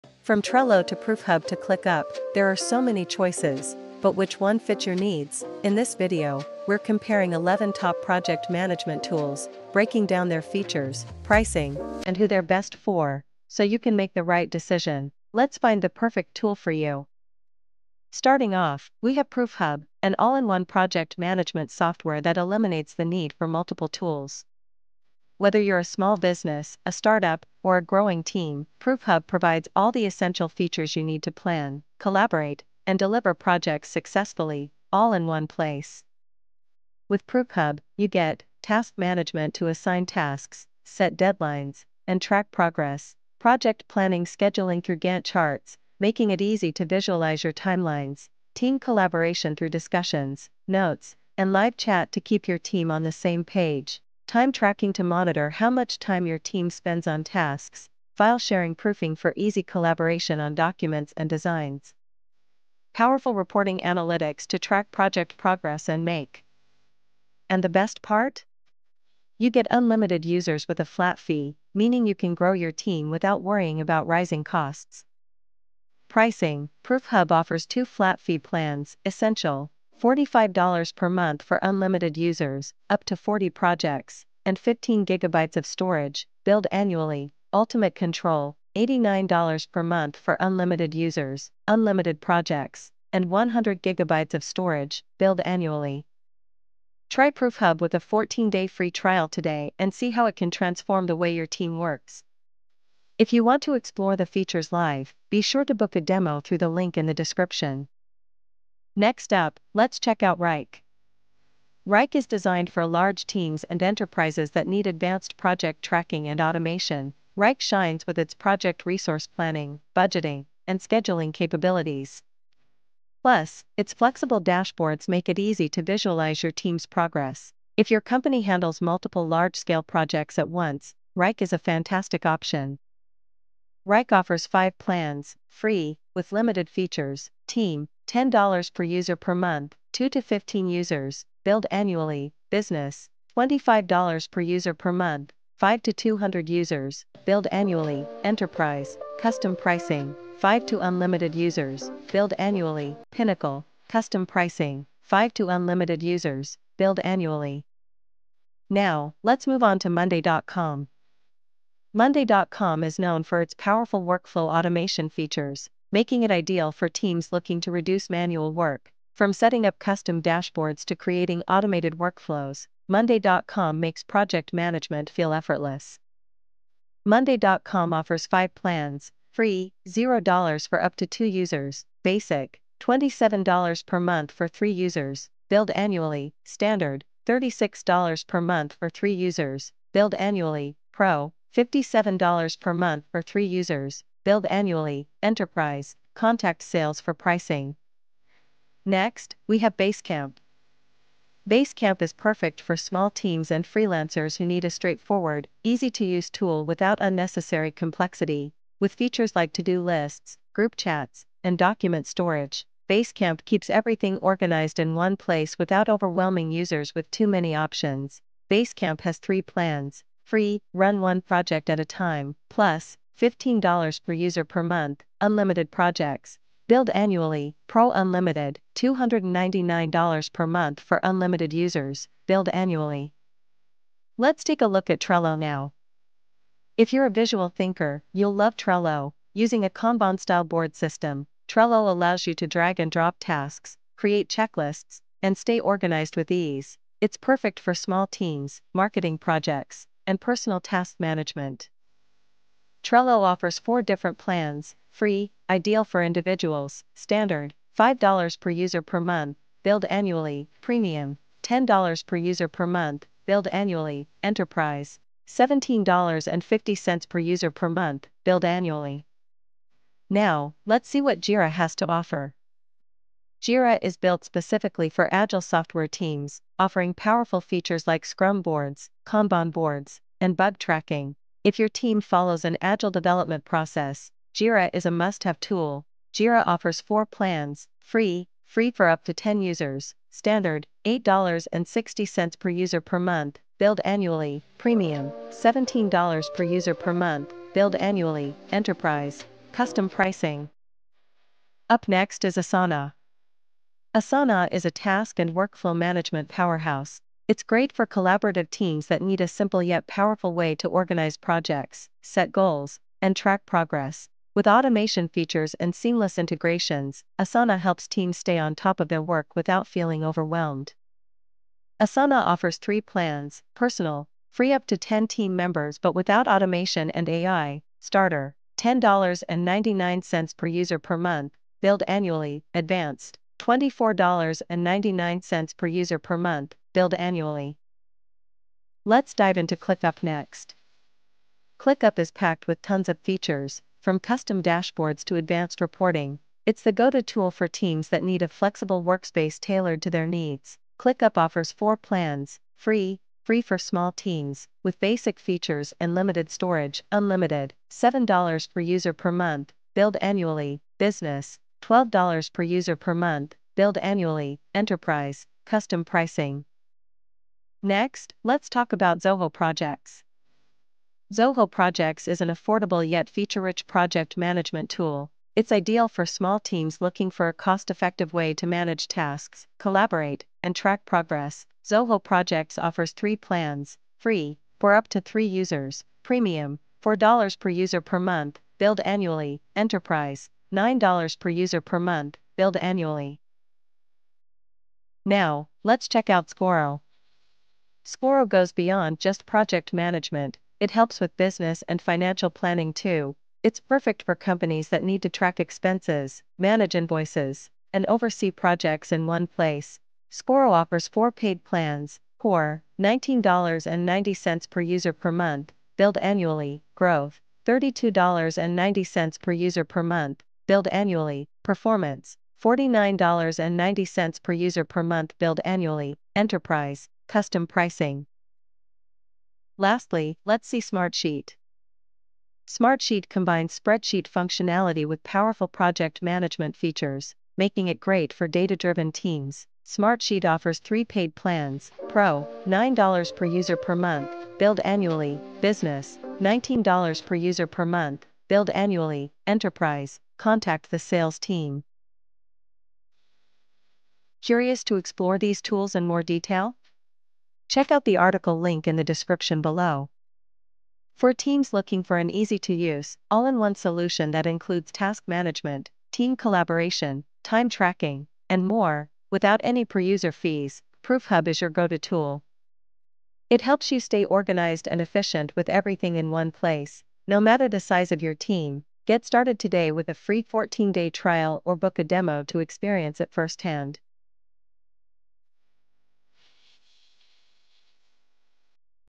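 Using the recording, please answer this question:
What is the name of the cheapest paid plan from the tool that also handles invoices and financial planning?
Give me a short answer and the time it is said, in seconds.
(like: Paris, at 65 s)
Core, at 412 s.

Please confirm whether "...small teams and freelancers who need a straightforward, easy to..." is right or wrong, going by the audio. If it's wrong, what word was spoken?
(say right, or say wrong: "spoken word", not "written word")
right.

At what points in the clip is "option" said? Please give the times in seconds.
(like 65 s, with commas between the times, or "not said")
132 s, 217 s.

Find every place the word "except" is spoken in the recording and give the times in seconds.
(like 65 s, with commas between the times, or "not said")
not said.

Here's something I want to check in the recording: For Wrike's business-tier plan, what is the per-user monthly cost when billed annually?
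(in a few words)
$25.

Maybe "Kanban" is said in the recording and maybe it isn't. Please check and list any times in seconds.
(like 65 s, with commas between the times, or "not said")
239 s, 279 s.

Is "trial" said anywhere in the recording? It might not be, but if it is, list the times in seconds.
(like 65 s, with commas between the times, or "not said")
98 s, 480 s.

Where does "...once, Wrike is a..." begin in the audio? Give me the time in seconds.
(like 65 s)
130 s.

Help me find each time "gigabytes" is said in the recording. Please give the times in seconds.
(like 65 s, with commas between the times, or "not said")
85 s, 93 s.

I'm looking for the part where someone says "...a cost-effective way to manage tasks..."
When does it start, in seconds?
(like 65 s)
377 s.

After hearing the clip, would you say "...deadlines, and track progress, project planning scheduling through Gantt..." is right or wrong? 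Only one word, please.
right.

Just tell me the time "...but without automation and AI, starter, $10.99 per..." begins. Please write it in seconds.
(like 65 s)
325 s.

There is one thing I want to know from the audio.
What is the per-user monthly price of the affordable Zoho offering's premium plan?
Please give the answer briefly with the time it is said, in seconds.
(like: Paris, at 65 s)
$4, at 386 s.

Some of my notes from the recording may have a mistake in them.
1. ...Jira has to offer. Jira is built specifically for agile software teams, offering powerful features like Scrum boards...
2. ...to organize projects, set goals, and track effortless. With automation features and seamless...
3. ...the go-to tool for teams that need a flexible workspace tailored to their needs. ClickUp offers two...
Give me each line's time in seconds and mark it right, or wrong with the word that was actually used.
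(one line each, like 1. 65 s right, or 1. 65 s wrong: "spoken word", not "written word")
1. 271 s right
2. 310 s wrong: "progress", not "effortless"
3. 346 s wrong: "four", not "two".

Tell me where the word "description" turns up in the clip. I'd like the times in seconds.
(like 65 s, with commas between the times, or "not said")
107 s, 458 s.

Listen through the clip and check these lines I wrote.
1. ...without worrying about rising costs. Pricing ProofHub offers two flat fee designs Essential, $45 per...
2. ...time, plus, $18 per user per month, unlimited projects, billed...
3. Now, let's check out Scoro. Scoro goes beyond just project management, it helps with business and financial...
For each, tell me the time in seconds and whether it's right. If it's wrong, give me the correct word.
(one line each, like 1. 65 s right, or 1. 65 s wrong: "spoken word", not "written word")
1. 73 s wrong: "plans", not "designs"
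2. 221 s wrong: "15", not "18"
3. 395 s right.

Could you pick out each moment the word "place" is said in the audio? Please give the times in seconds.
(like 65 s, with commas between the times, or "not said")
35 s, 215 s, 409 s, 476 s.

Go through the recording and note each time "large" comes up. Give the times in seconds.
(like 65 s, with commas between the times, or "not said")
112 s, 129 s.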